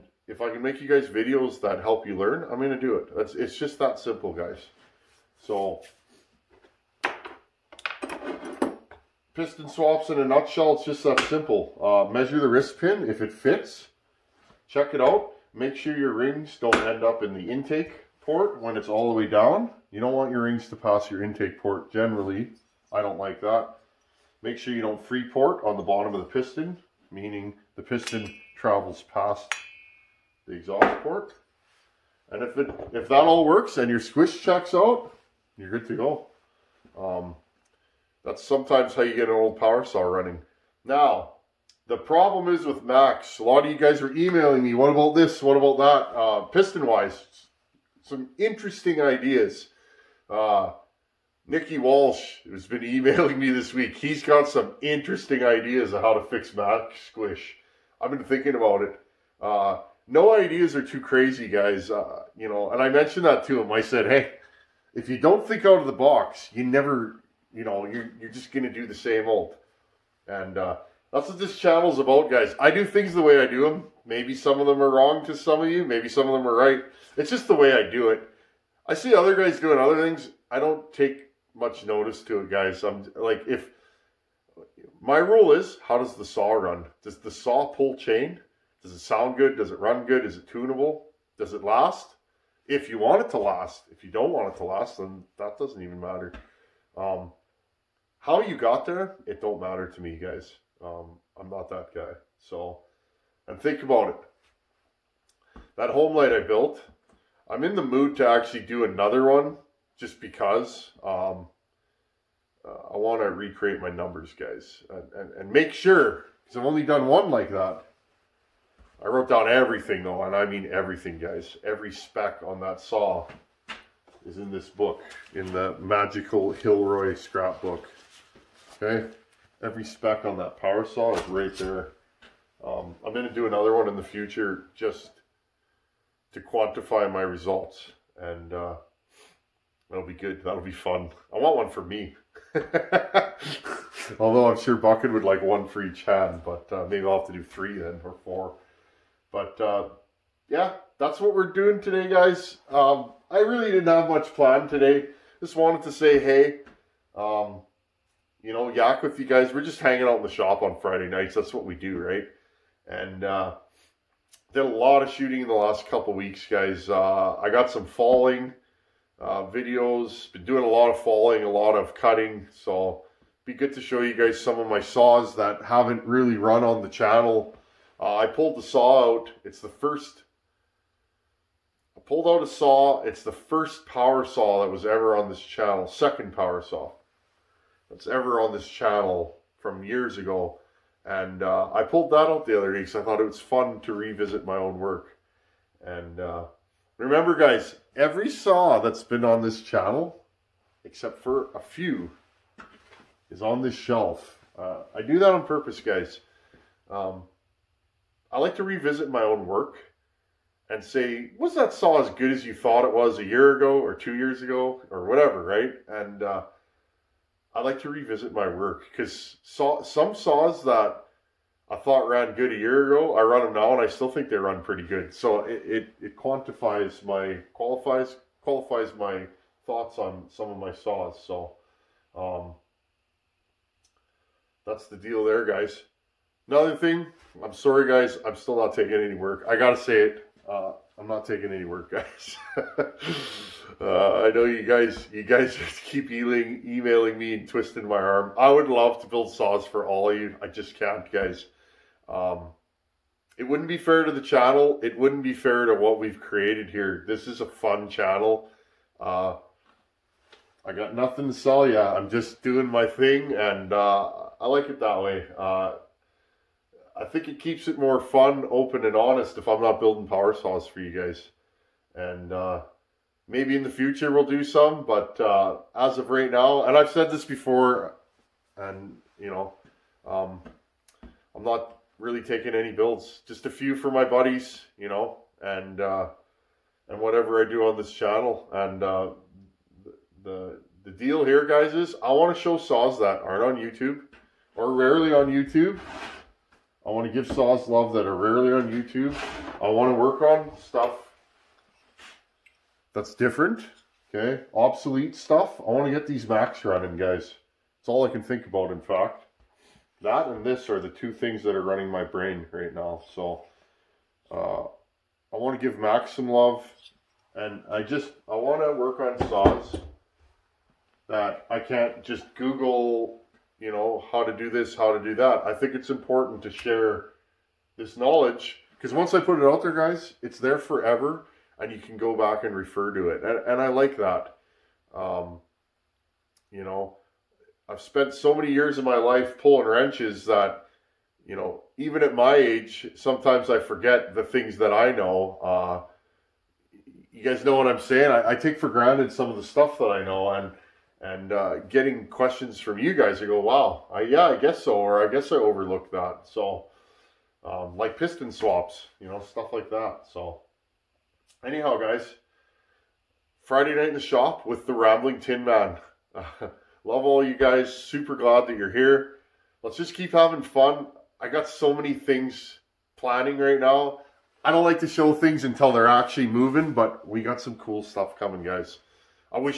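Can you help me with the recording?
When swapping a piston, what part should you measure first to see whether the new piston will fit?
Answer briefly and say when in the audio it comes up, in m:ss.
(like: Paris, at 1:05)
Wrist pin, at 0:12.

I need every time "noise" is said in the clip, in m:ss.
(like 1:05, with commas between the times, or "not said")
not said.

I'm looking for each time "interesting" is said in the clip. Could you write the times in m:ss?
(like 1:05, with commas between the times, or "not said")
0:48, 0:54.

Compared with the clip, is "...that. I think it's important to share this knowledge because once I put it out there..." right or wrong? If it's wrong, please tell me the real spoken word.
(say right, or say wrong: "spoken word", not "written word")
right.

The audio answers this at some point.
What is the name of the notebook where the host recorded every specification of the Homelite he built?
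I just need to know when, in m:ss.
2:05.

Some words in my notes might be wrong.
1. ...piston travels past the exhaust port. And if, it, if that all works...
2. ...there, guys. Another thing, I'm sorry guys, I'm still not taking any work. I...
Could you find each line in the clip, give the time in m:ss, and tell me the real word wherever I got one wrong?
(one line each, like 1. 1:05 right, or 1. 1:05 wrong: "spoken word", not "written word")
1. 0:27 right
2. 3:55 right.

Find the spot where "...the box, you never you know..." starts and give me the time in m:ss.
1:05.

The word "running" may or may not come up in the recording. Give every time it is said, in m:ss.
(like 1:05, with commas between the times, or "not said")
0:40, 5:06, 5:11.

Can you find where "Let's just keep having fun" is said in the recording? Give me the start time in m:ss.
6:09.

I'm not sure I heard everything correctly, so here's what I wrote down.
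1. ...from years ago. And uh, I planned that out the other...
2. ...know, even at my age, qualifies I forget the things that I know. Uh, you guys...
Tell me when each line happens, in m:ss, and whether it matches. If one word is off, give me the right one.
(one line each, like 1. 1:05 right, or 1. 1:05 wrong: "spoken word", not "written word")
1. 3:09 wrong: "pulled", not "planned"
2. 5:41 wrong: "sometimes", not "qualifies".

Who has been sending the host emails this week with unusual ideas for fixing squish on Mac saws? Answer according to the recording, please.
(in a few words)
Nikki Walsh.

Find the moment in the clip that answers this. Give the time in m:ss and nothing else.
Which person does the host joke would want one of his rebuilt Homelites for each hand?
2:24.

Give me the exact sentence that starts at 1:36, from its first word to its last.
Um, how you got there, it don't matter to me, guys.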